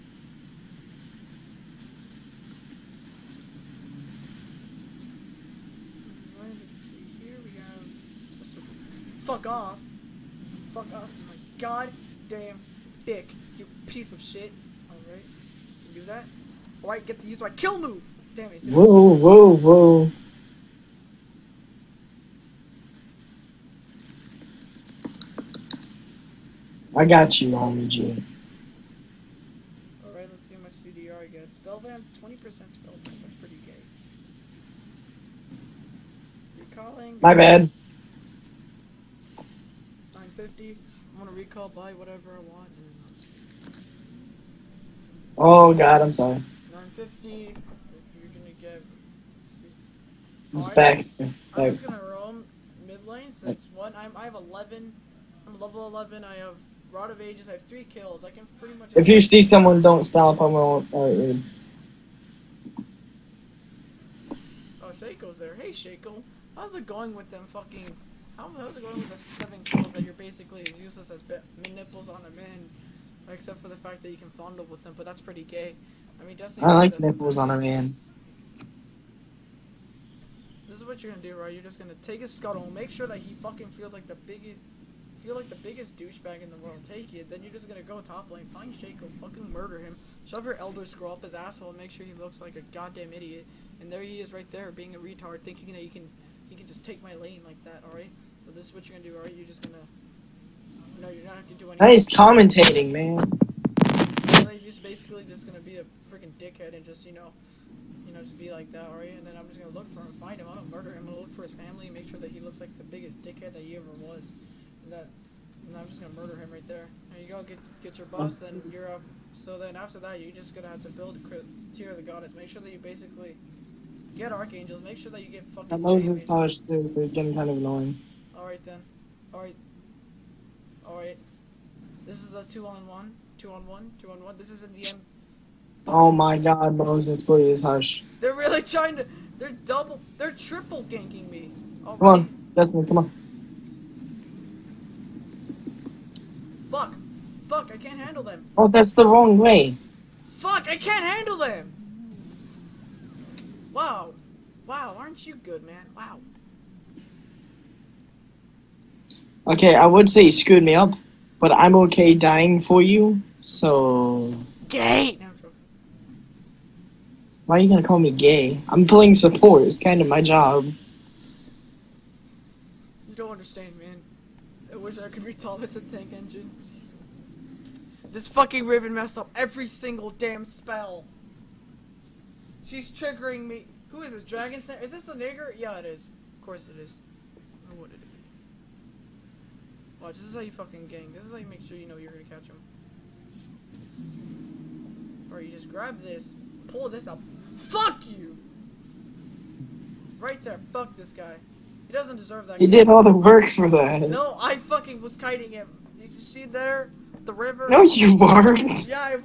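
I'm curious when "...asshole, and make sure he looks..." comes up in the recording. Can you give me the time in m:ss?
1:31.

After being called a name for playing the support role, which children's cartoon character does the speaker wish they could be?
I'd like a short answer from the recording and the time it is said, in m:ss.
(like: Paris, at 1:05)
Thomas the Tank Engine, at 2:55.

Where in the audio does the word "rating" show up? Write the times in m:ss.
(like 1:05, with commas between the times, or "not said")
not said.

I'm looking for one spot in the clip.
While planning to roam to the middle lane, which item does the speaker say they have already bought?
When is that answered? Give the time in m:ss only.
0:56.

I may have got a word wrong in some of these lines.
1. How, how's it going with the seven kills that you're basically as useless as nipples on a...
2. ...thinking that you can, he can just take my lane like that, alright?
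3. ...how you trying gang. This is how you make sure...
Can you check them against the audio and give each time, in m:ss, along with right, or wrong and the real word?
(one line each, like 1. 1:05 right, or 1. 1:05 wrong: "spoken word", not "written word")
1. 1:08 right
2. 1:35 right
3. 3:10 wrong: "fucking", not "trying".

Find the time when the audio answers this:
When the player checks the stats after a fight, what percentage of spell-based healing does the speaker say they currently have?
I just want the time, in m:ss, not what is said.
0:32.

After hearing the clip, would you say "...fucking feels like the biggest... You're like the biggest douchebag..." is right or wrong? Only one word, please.
right.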